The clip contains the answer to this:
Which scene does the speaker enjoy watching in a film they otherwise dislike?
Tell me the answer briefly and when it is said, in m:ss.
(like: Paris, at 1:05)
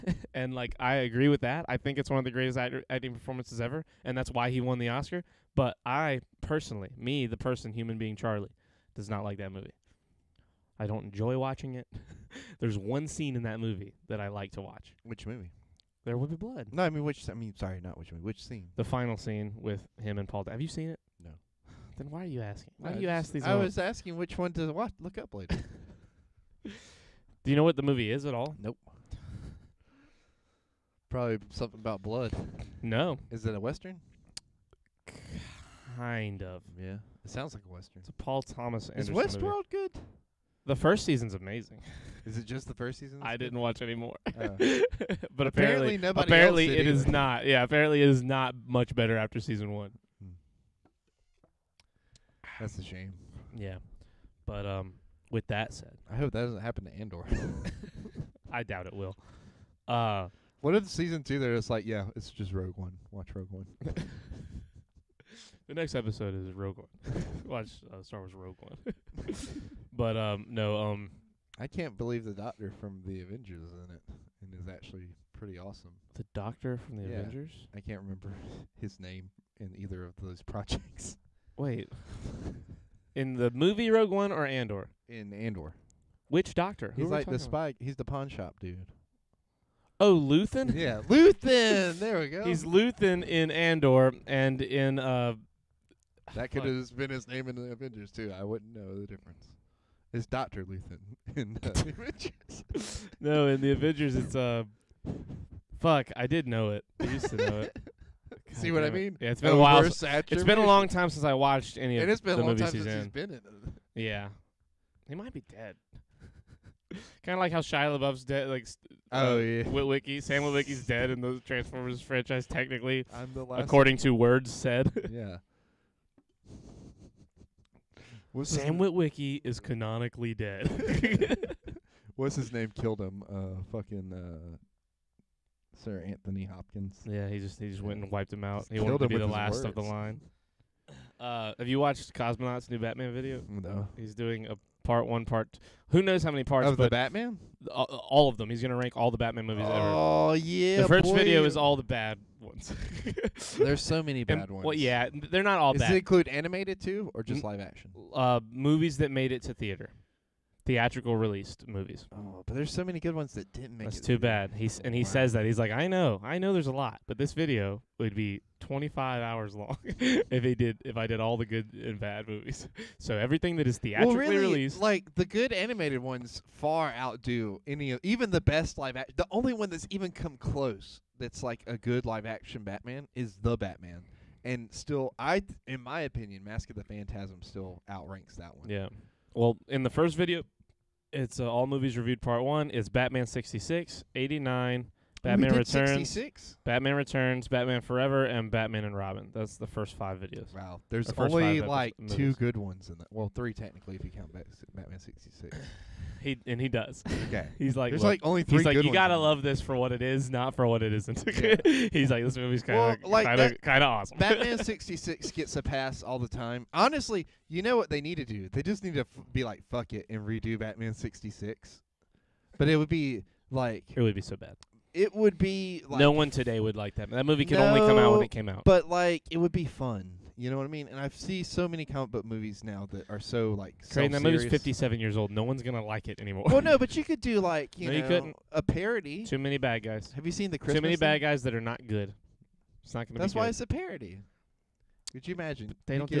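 The final scene, at 0:18.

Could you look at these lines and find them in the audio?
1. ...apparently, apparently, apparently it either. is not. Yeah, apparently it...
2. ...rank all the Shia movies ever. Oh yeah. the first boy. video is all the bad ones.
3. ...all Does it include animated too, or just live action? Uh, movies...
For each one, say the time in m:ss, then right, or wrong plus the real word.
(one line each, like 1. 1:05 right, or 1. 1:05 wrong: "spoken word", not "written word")
1. 0:45 right
2. 2:28 wrong: "Batman", not "Shia"
3. 2:35 right.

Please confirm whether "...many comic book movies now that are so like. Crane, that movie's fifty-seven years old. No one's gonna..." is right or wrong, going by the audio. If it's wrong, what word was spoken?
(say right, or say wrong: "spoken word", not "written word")
right.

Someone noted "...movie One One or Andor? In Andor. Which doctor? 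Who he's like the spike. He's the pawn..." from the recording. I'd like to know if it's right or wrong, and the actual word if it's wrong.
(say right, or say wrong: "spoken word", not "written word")
wrong: "Rogue", not "One".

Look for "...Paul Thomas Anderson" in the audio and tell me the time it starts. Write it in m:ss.
0:38.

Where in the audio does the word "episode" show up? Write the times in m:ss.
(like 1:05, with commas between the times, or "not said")
1:05, 3:21.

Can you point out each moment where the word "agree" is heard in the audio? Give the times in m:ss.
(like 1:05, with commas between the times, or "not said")
0:00.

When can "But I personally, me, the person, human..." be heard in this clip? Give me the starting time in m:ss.
0:05.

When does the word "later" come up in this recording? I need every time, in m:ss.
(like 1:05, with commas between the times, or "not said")
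0:25.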